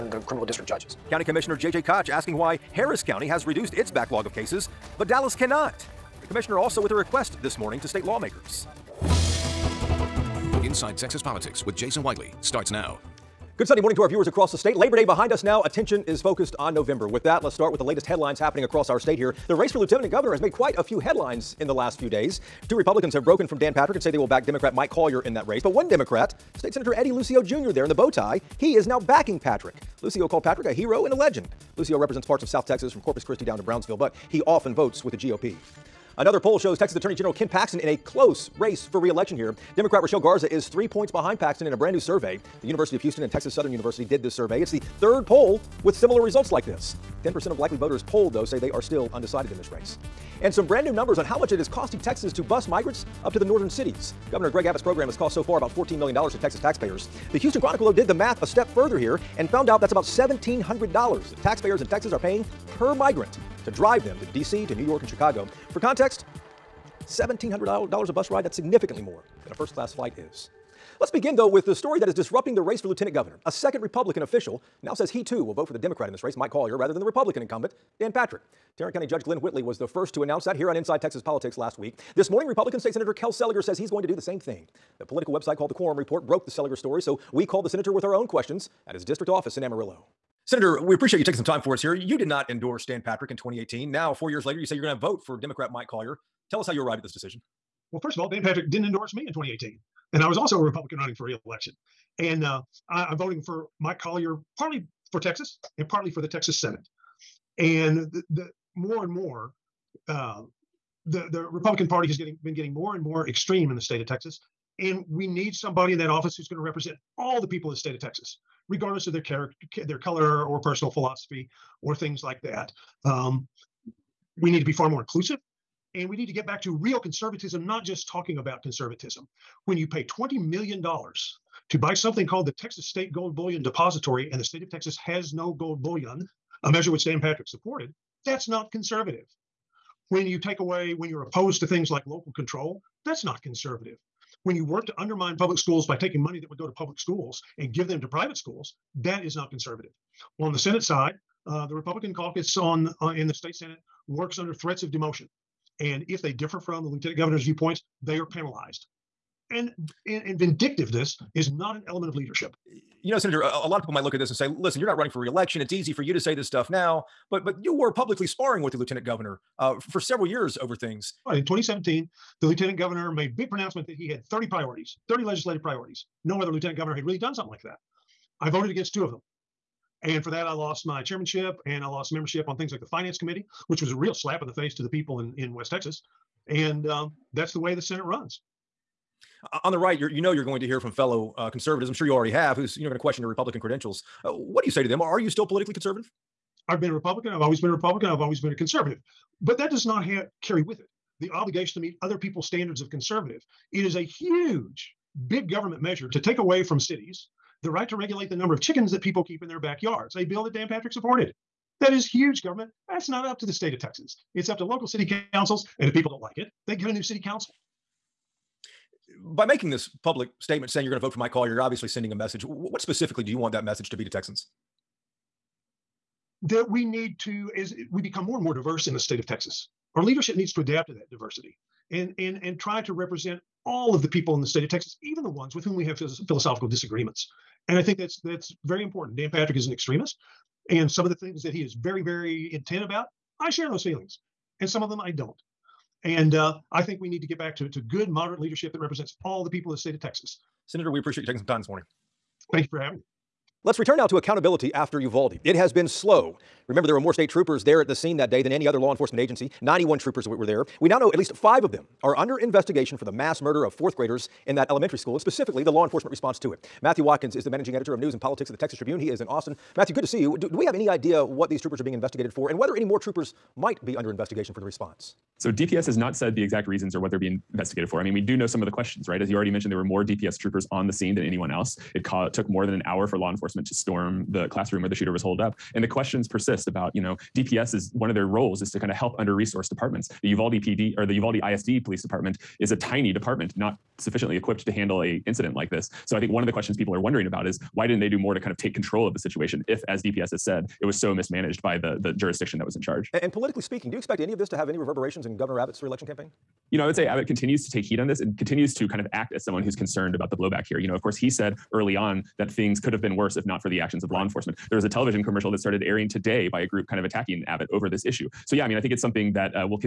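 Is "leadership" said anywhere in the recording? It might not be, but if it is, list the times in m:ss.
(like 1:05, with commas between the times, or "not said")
2:42, 3:50, 4:08.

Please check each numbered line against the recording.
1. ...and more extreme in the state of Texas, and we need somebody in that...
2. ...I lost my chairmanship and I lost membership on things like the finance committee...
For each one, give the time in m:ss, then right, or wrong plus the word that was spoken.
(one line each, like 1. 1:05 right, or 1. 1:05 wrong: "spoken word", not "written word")
1. 1:52 right
2. 3:00 right.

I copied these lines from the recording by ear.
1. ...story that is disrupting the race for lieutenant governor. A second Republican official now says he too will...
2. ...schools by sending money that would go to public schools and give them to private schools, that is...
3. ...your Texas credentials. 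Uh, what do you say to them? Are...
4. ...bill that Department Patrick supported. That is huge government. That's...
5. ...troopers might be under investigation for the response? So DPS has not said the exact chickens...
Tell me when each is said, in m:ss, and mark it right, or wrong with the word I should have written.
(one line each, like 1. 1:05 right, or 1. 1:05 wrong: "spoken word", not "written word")
1. 1:11 right
2. 2:25 wrong: "taking", not "sending"
3. 3:13 wrong: "Republican", not "Texas"
4. 3:30 wrong: "Dan", not "Department"
5. 4:32 wrong: "reasons", not "chickens".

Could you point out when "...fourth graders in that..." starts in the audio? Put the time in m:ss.
4:23.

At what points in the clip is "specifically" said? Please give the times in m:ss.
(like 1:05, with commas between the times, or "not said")
3:42, 4:25.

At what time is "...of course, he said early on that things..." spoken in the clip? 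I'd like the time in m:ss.
5:10.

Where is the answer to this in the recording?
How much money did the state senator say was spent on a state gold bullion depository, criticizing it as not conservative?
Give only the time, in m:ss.
2:10.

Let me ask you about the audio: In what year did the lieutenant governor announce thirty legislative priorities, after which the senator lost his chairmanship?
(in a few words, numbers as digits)
2017.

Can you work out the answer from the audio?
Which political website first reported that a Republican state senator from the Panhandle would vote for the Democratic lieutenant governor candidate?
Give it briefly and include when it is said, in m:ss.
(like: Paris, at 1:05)
Quorum Report, at 1:25.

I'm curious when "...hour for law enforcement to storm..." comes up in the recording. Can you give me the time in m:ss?
4:42.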